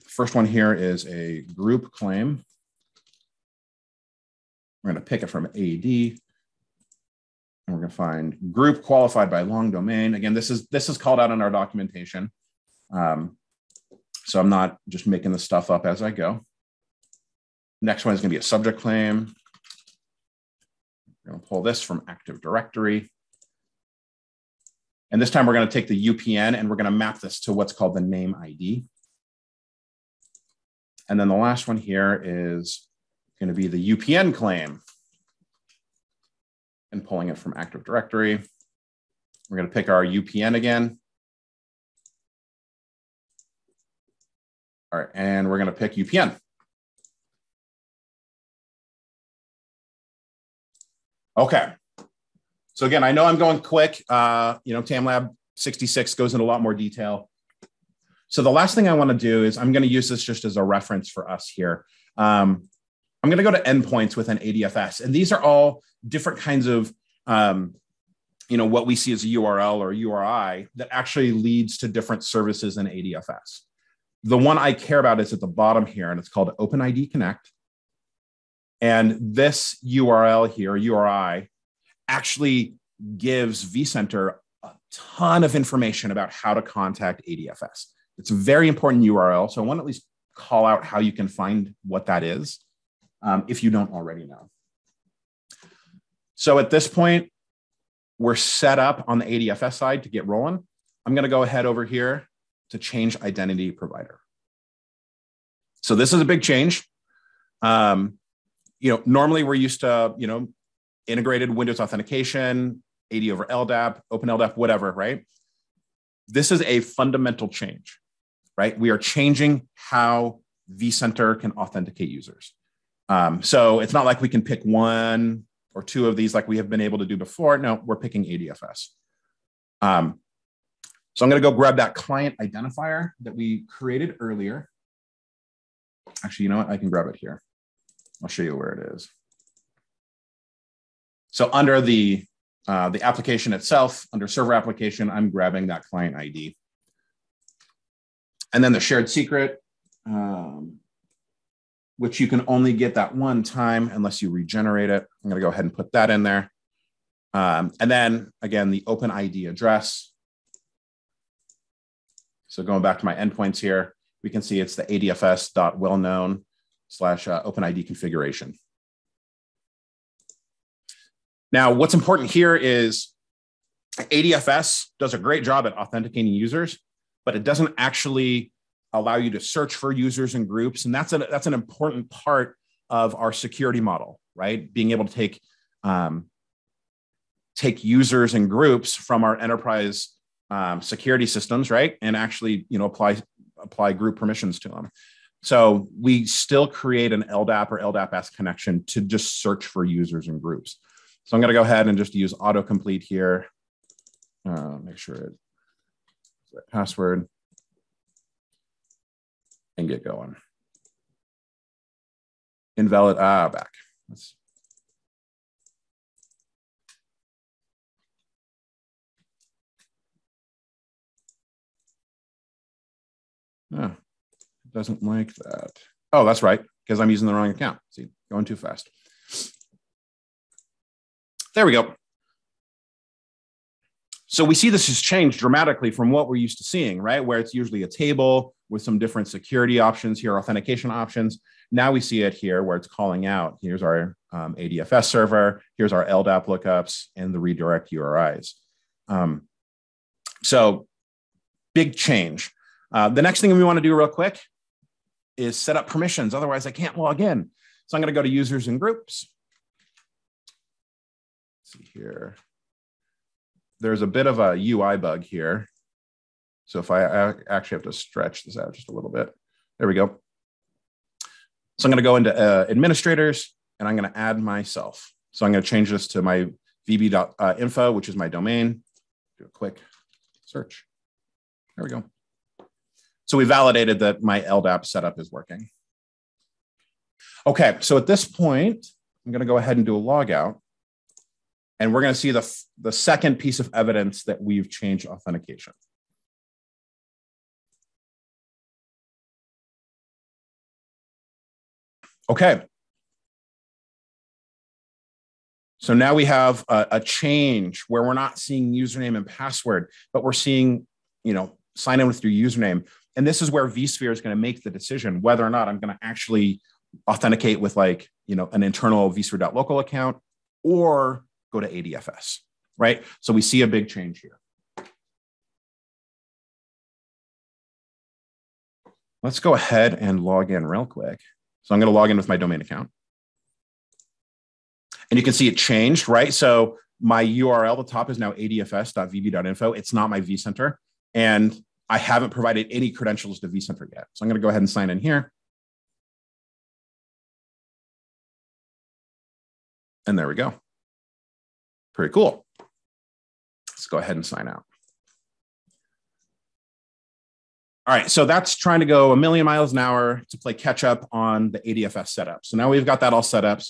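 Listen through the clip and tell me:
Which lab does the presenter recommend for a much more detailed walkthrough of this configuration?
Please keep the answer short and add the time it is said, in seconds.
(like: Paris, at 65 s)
TamLab 66, at 54 s.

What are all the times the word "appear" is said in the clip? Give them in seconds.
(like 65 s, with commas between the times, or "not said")
not said.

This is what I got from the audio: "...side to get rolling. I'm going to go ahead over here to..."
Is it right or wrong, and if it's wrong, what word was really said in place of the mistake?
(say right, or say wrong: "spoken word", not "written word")
right.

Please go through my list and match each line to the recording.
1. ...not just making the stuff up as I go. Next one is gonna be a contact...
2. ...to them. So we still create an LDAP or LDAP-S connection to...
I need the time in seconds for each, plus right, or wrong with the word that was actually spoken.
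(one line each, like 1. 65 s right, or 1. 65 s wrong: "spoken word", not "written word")
1. 14 s wrong: "subject", not "contact"
2. 194 s right.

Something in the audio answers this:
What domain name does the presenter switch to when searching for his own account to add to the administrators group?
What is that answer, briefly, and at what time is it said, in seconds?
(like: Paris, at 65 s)
vb.info, at 276 s.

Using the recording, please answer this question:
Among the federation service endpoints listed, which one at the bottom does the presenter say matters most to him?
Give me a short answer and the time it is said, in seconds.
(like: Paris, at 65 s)
OpenID Connect, at 76 s.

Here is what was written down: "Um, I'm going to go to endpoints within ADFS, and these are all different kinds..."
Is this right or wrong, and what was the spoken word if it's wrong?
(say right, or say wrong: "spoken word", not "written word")
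right.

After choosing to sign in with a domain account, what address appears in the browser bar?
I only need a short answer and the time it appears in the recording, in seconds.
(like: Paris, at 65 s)
adfs.vb.info, at 338 s.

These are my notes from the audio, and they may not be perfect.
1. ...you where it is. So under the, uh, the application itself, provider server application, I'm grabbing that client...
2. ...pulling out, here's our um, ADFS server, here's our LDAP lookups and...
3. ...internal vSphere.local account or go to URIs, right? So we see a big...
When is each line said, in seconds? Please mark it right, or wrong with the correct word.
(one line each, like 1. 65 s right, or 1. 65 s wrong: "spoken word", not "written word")
1. 138 s wrong: "under", not "provider"
2. 242 s wrong: "calling", not "pulling"
3. 318 s wrong: "ADFS", not "URIs".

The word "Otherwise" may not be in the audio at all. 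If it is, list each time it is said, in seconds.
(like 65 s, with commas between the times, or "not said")
256 s.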